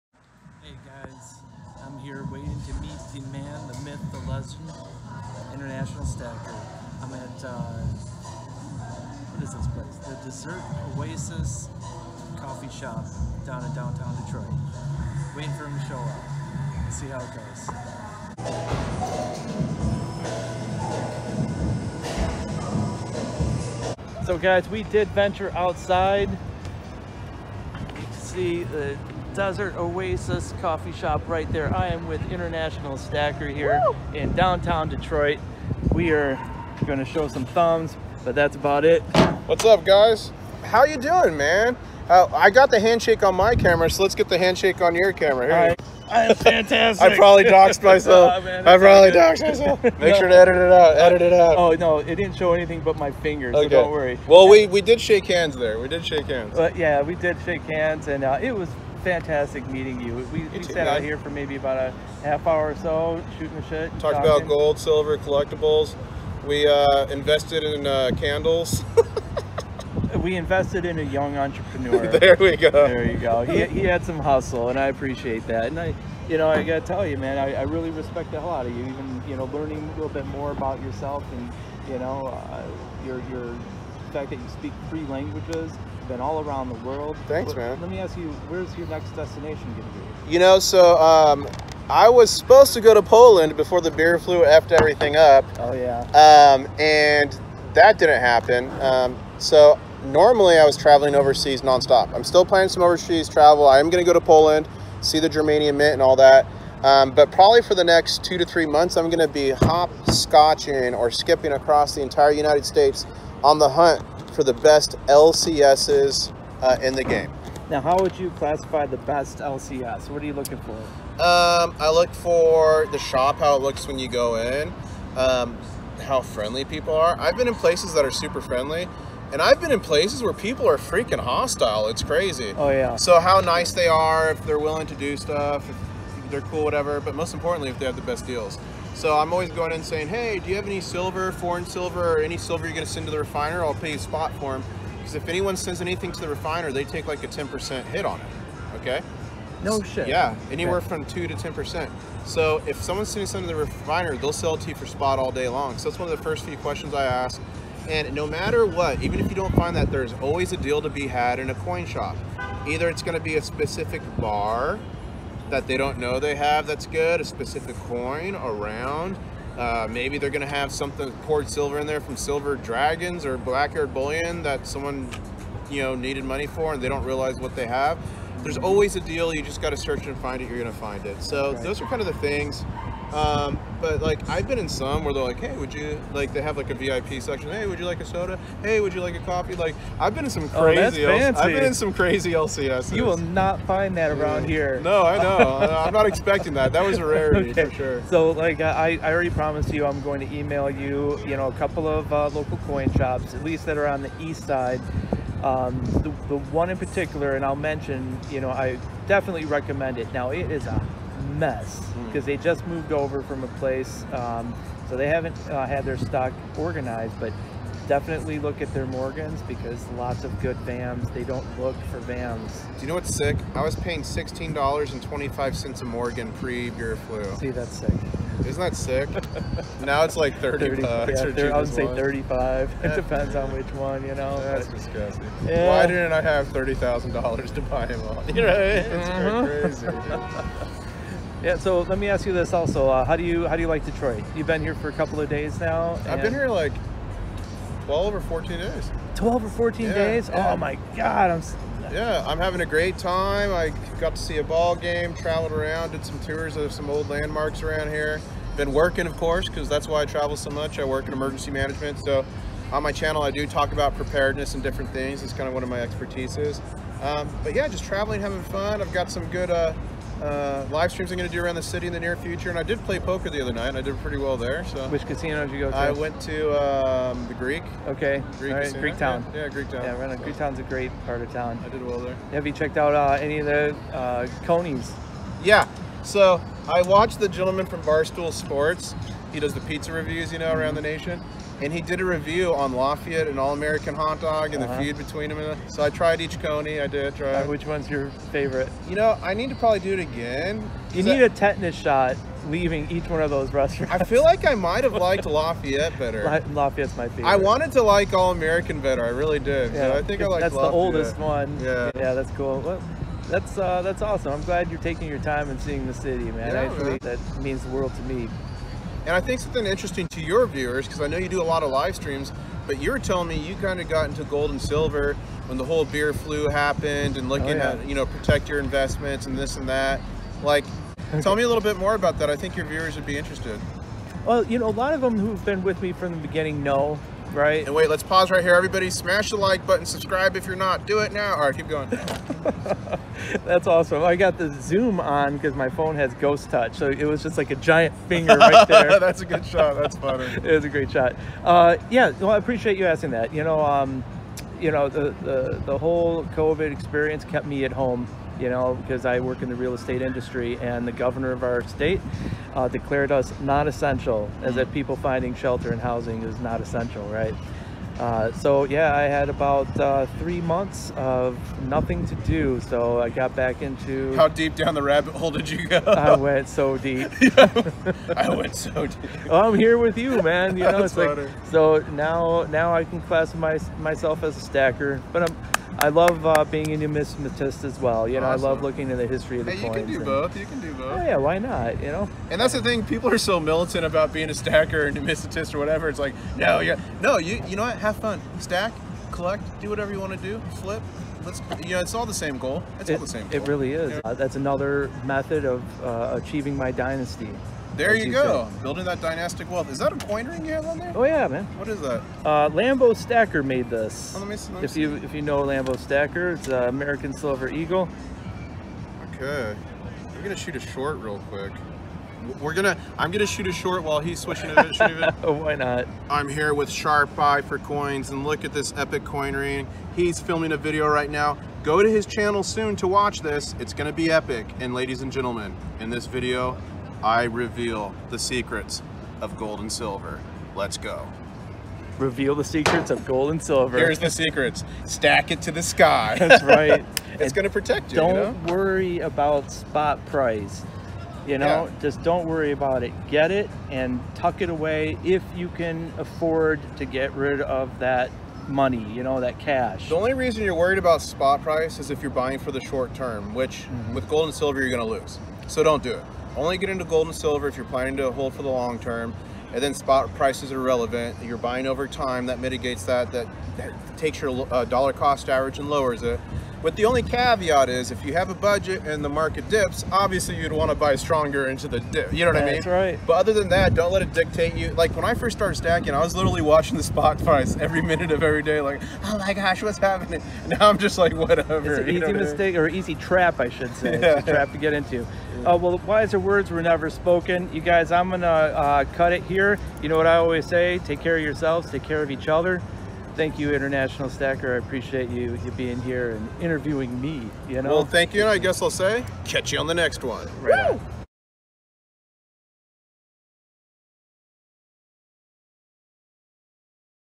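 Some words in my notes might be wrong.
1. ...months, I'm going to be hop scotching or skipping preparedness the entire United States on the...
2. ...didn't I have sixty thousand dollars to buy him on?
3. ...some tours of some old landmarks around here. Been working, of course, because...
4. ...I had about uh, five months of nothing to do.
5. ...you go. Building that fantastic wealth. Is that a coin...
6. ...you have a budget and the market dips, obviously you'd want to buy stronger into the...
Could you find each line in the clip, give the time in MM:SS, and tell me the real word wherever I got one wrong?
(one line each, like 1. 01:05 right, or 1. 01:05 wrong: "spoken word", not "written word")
1. 01:48 wrong: "across", not "preparedness"
2. 03:55 wrong: "thirty", not "sixty"
3. 04:16 right
4. 06:08 wrong: "three", not "five"
5. 06:47 wrong: "dynastic", not "fantastic"
6. 07:58 right.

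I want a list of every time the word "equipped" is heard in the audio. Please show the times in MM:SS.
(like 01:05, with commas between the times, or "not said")
not said.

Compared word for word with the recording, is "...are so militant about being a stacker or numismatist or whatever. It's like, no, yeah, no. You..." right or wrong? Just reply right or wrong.
right.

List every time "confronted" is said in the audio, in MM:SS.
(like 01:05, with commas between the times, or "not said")
not said.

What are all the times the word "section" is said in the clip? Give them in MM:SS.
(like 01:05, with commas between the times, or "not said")
03:07.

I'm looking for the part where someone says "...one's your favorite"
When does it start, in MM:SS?
04:57.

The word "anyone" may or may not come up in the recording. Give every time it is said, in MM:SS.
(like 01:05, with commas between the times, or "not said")
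02:25.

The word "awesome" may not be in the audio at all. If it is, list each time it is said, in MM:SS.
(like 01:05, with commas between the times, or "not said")
05:14, 05:43, 06:28.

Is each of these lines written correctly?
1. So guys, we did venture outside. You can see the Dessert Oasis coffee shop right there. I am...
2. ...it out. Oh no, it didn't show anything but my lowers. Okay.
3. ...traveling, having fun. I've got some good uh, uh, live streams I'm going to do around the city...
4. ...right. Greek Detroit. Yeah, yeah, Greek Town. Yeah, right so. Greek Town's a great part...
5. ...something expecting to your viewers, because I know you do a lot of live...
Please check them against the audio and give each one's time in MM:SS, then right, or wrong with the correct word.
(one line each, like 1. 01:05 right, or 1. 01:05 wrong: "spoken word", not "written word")
1. 00:24 right
2. 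00:51 wrong: "fingers", not "lowers"
3. 04:27 right
4. 04:38 wrong: "Town", not "Detroit"
5. 05:19 wrong: "interesting", not "expecting".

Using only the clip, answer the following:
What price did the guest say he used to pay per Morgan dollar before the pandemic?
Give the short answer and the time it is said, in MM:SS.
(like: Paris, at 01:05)
$16.25, at 03:44.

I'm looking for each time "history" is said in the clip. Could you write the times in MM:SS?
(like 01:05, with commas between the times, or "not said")
06:29.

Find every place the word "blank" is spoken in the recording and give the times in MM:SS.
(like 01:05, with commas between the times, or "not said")
not said.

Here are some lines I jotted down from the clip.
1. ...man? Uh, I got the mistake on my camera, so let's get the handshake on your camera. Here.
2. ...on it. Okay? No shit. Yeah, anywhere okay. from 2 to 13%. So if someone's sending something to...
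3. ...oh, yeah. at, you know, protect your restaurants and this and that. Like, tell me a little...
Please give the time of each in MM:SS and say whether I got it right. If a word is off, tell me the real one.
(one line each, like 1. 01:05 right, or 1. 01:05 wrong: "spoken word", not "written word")
1. 00:41 wrong: "handshake", not "mistake"
2. 02:28 wrong: "10", not "13"
3. 05:27 wrong: "investments", not "restaurants".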